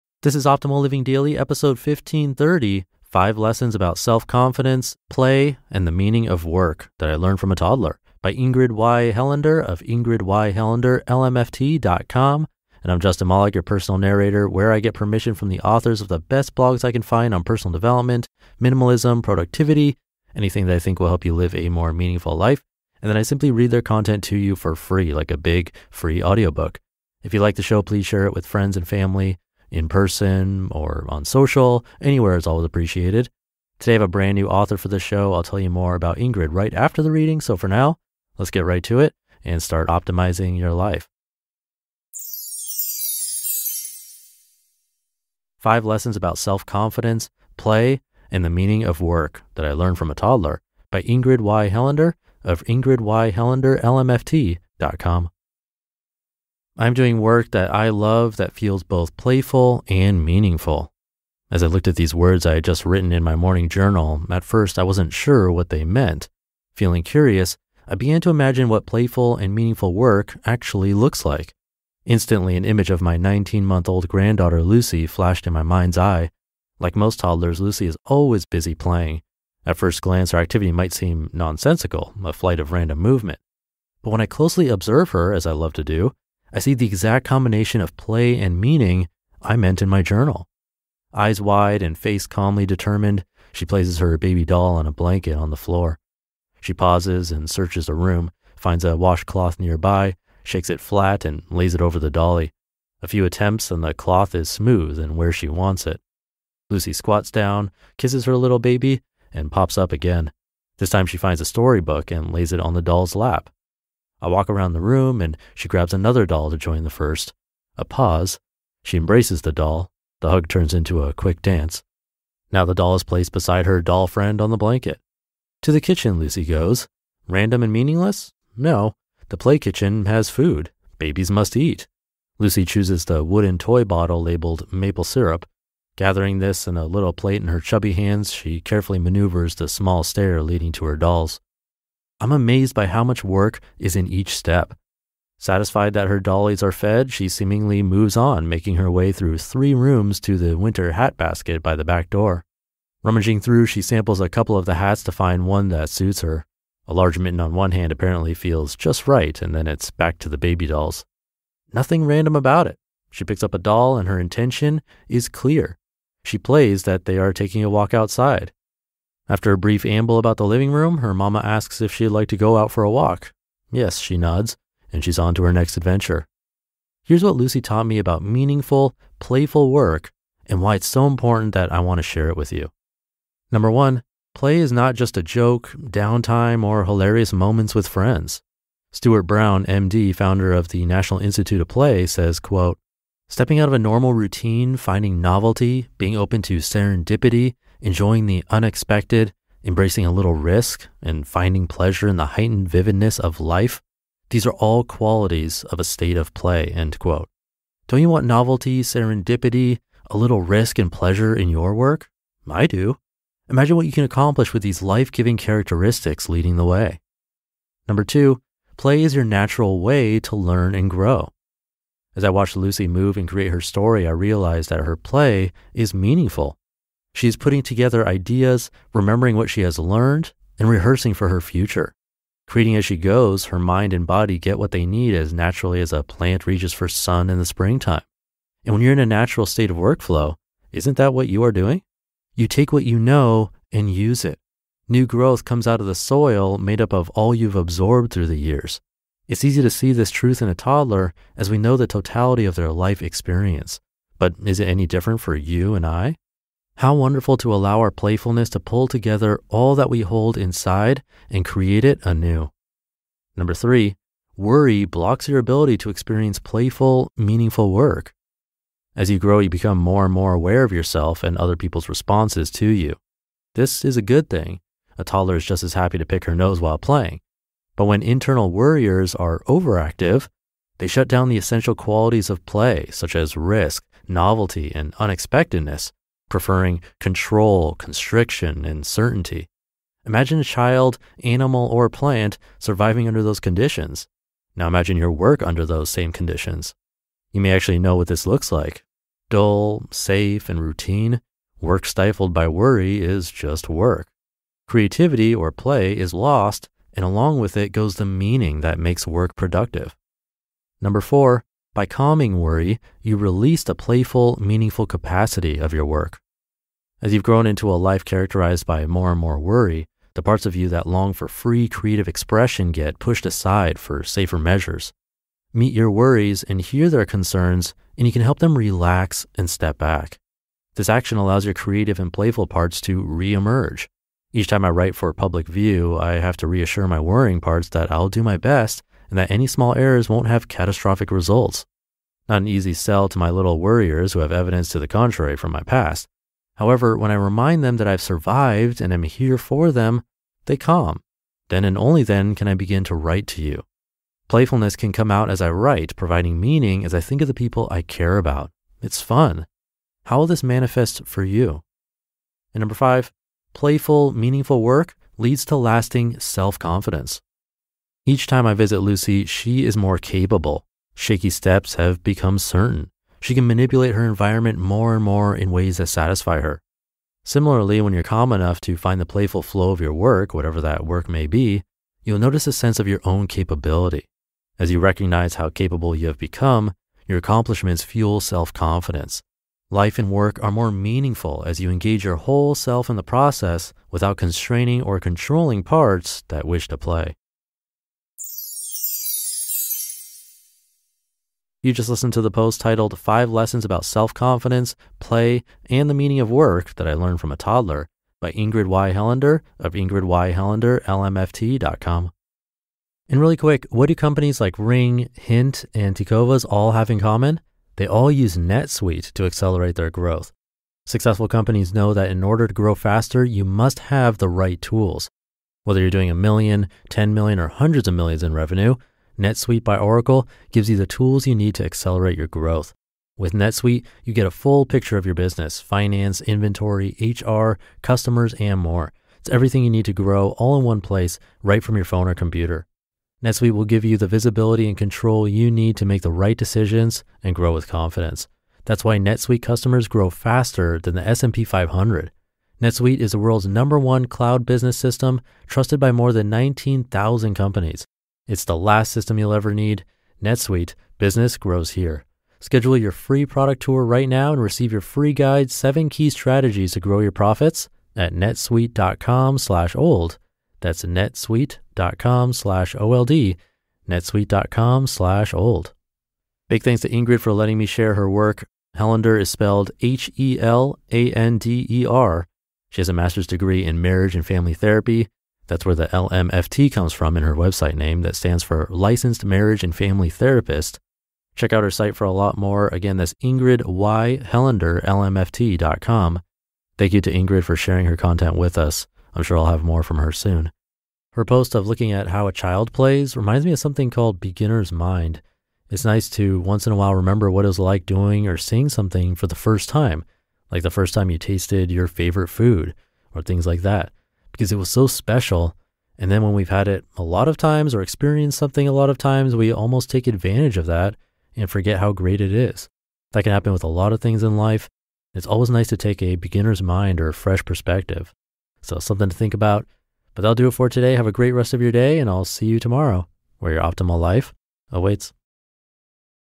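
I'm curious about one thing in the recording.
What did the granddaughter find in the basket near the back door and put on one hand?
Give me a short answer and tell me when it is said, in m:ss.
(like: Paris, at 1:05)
A large mitten, at 2:36.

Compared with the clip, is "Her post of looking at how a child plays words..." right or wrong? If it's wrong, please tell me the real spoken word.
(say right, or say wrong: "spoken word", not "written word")
wrong: "reminds", not "words".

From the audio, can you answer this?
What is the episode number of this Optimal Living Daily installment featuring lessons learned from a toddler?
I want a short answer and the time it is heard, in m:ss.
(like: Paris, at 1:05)
1530, at 0:01.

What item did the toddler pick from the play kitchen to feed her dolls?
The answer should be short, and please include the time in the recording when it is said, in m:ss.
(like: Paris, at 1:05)
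Maple syrup, at 2:14.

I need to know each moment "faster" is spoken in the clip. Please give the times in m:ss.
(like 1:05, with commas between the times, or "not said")
7:02, 7:30.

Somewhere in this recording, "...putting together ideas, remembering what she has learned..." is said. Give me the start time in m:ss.
3:47.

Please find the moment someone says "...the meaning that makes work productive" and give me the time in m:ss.
5:07.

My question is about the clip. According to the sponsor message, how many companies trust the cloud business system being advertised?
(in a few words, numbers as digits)
19,000.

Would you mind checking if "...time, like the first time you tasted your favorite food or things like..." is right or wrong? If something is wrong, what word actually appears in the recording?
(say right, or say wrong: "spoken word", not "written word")
right.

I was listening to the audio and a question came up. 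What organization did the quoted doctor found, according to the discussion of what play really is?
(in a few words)
National Institute of Play.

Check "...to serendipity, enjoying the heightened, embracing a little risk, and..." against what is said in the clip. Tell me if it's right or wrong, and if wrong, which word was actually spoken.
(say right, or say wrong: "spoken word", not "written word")
wrong: "unexpected", not "heightened".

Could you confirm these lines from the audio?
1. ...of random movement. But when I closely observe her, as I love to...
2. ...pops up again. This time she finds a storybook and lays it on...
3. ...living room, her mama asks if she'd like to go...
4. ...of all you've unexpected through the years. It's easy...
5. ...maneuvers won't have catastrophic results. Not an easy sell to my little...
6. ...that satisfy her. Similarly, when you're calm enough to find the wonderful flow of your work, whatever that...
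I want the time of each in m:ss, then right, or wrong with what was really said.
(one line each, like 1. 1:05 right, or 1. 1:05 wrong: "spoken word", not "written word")
1. 1:22 right
2. 1:49 right
3. 2:50 right
4. 4:06 wrong: "absorbed", not "unexpected"
5. 5:39 wrong: "errors", not "maneuvers"
6. 6:15 wrong: "playful", not "wonderful".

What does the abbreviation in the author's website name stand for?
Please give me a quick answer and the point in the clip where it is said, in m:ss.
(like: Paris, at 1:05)
Licensed Marriage and Family Therapist, at 8:08.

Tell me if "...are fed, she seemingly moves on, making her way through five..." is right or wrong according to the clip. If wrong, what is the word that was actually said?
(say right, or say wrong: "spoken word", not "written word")
wrong: "three", not "five".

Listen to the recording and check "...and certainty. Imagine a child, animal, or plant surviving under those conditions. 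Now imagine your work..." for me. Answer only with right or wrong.
right.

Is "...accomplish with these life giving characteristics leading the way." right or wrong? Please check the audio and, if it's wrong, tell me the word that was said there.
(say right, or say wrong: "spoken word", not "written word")
right.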